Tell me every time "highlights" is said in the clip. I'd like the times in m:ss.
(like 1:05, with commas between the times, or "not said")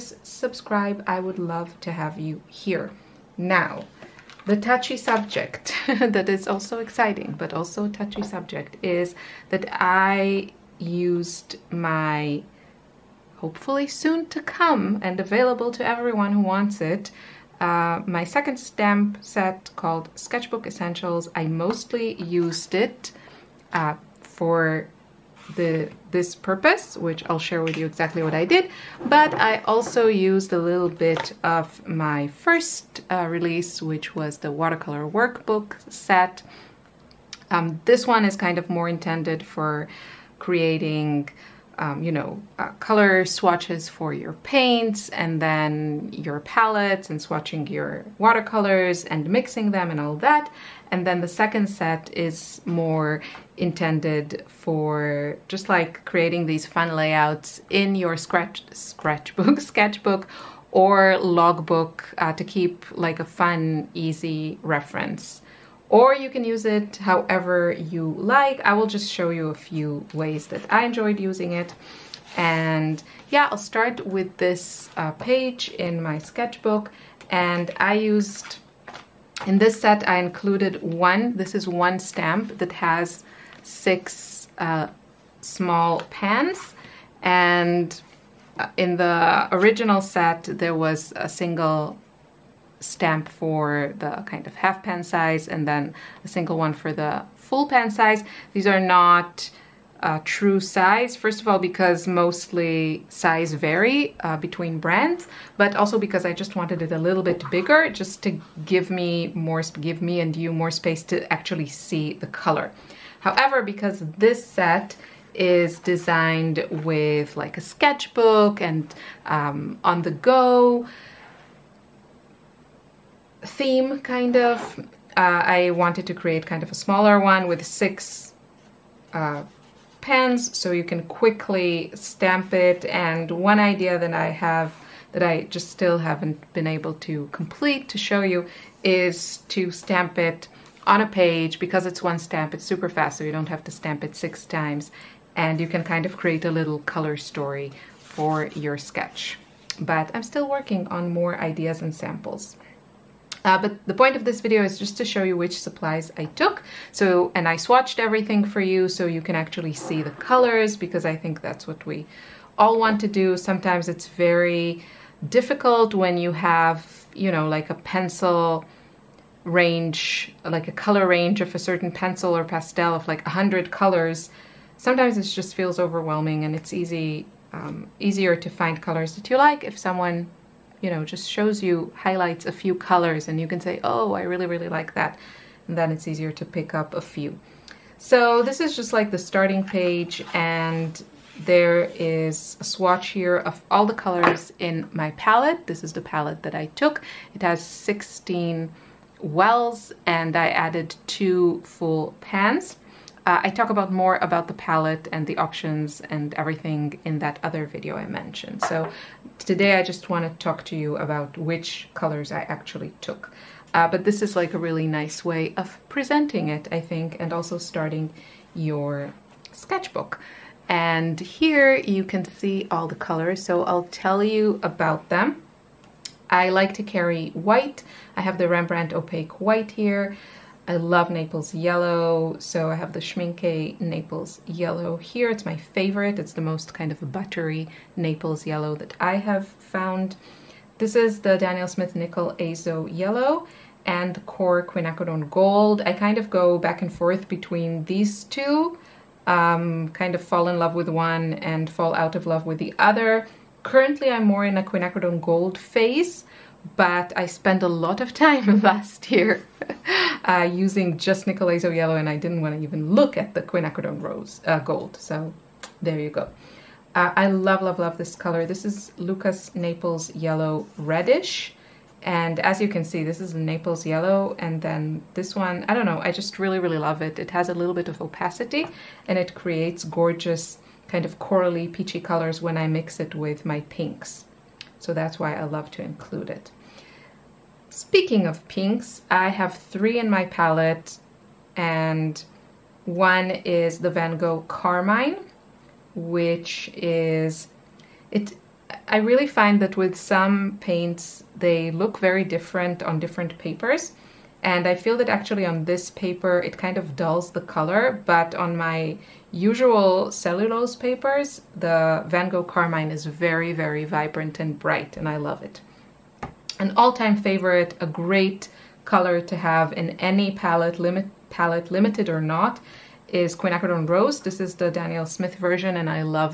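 3:01.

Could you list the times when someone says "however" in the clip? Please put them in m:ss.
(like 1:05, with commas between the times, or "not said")
1:06, 1:53.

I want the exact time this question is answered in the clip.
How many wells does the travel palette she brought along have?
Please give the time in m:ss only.
3:17.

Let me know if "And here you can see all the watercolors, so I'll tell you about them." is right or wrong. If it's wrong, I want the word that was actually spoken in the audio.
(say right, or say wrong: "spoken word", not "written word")
wrong: "colors", not "watercolors".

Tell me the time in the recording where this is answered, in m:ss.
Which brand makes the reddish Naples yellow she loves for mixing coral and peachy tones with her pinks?
4:28.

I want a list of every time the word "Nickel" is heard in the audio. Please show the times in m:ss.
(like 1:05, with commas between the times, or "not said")
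4:01, 4:21.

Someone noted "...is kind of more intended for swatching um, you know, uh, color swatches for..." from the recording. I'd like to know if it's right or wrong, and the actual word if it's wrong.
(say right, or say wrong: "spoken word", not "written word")
wrong: "creating", not "swatching".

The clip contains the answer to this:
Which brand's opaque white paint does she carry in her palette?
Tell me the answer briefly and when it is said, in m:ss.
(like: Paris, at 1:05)
Rembrandt, at 3:48.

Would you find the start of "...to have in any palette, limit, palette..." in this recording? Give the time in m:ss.
5:19.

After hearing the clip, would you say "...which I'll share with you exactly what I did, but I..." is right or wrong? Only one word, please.
right.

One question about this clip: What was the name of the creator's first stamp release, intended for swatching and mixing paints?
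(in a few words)
watercolor workbook set.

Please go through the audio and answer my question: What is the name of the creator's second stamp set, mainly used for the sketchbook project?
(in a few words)
Sketchbook Essentials.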